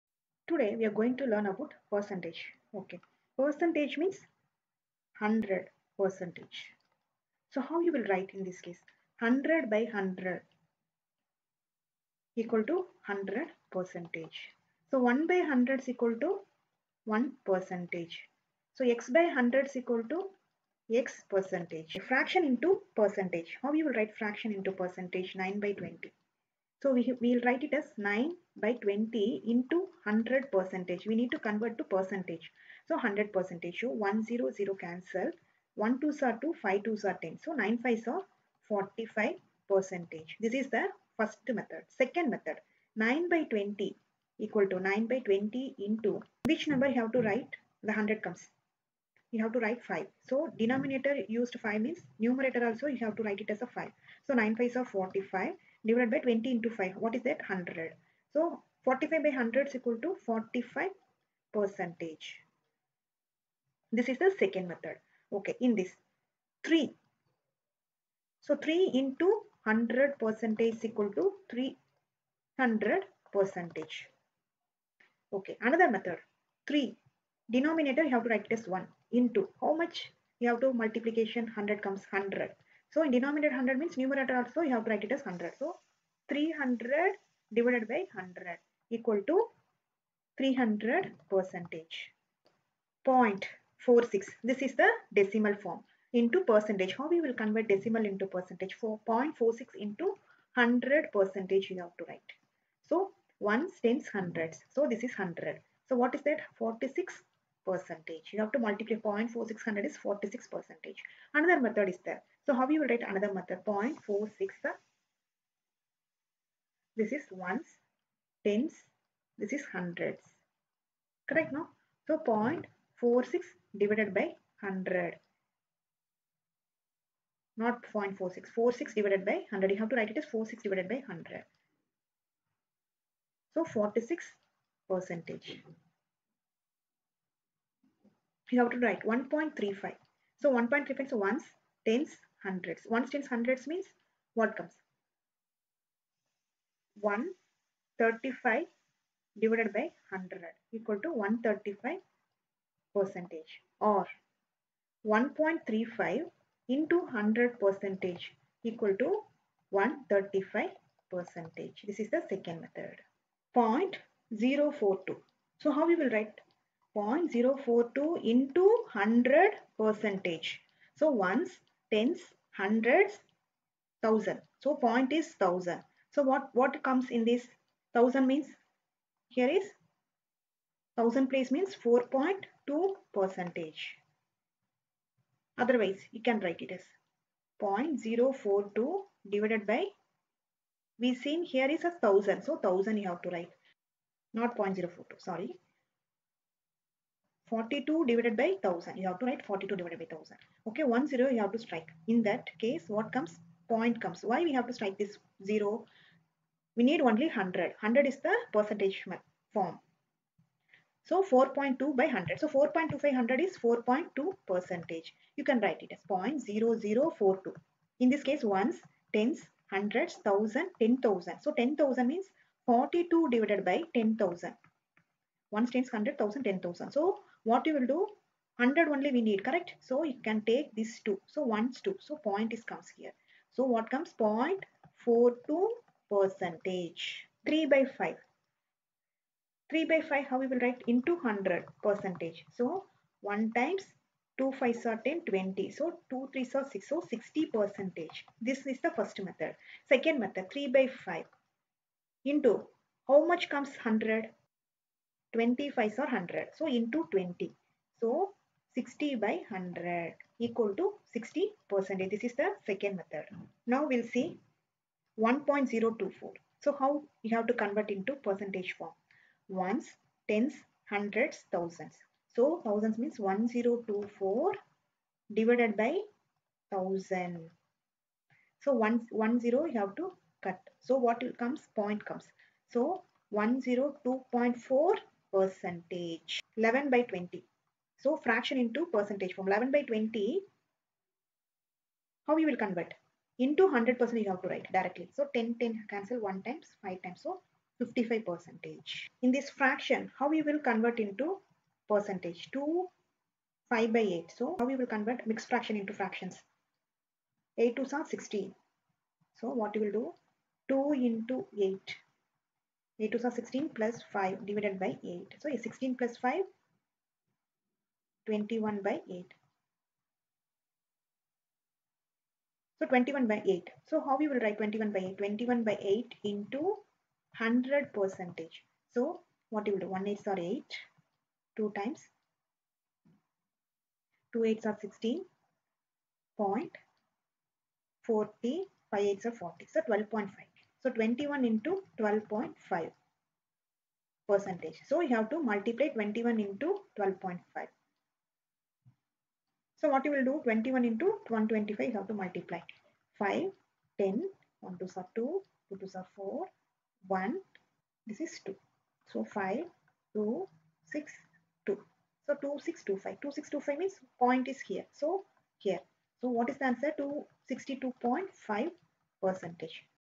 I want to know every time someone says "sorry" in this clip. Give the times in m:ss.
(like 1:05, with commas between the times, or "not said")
3:15.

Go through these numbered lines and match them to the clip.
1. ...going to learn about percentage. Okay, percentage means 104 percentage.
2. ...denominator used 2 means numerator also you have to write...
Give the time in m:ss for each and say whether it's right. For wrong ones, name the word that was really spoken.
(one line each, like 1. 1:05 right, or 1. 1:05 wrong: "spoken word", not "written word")
1. 0:00 wrong: "100", not "104"
2. 0:50 wrong: "5", not "2".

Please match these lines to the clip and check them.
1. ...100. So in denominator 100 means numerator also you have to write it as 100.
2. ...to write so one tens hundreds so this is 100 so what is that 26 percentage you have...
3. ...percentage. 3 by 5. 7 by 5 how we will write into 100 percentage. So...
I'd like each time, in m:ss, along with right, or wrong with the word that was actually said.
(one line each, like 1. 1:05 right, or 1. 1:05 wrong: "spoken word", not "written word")
1. 1:22 right
2. 1:42 wrong: "46", not "26"
3. 3:56 wrong: "3", not "7".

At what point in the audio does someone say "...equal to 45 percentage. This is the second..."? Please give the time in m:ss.
0:59.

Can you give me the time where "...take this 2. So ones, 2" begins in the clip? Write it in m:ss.
3:50.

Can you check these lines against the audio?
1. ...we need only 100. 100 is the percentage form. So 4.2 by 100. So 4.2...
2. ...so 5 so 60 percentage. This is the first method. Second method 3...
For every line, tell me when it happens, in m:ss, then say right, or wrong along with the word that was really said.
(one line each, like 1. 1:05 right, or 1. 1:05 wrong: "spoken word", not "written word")
1. 3:26 right
2. 4:06 wrong: "6", not "5".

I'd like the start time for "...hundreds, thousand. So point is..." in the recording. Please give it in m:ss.
2:52.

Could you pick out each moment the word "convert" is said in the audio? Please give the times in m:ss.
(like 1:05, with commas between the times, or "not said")
0:31, 1:37, 4:27, 4:52, 5:00, 5:04.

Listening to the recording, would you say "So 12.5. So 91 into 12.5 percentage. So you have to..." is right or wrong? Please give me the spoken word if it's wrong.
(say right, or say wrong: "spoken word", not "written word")
wrong: "21", not "91".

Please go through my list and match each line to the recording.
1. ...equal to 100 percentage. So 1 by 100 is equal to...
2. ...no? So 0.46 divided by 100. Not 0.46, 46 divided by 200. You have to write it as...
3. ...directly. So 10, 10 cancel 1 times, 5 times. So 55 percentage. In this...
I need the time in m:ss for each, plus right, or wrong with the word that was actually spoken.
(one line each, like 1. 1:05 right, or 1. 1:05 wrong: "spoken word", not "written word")
1. 0:12 right
2. 2:01 wrong: "100", not "200"
3. 4:54 right.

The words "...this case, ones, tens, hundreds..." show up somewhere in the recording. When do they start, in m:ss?
3:38.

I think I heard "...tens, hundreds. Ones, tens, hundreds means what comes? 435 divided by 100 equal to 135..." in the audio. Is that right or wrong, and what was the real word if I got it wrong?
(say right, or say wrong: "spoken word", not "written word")
wrong: "135", not "435".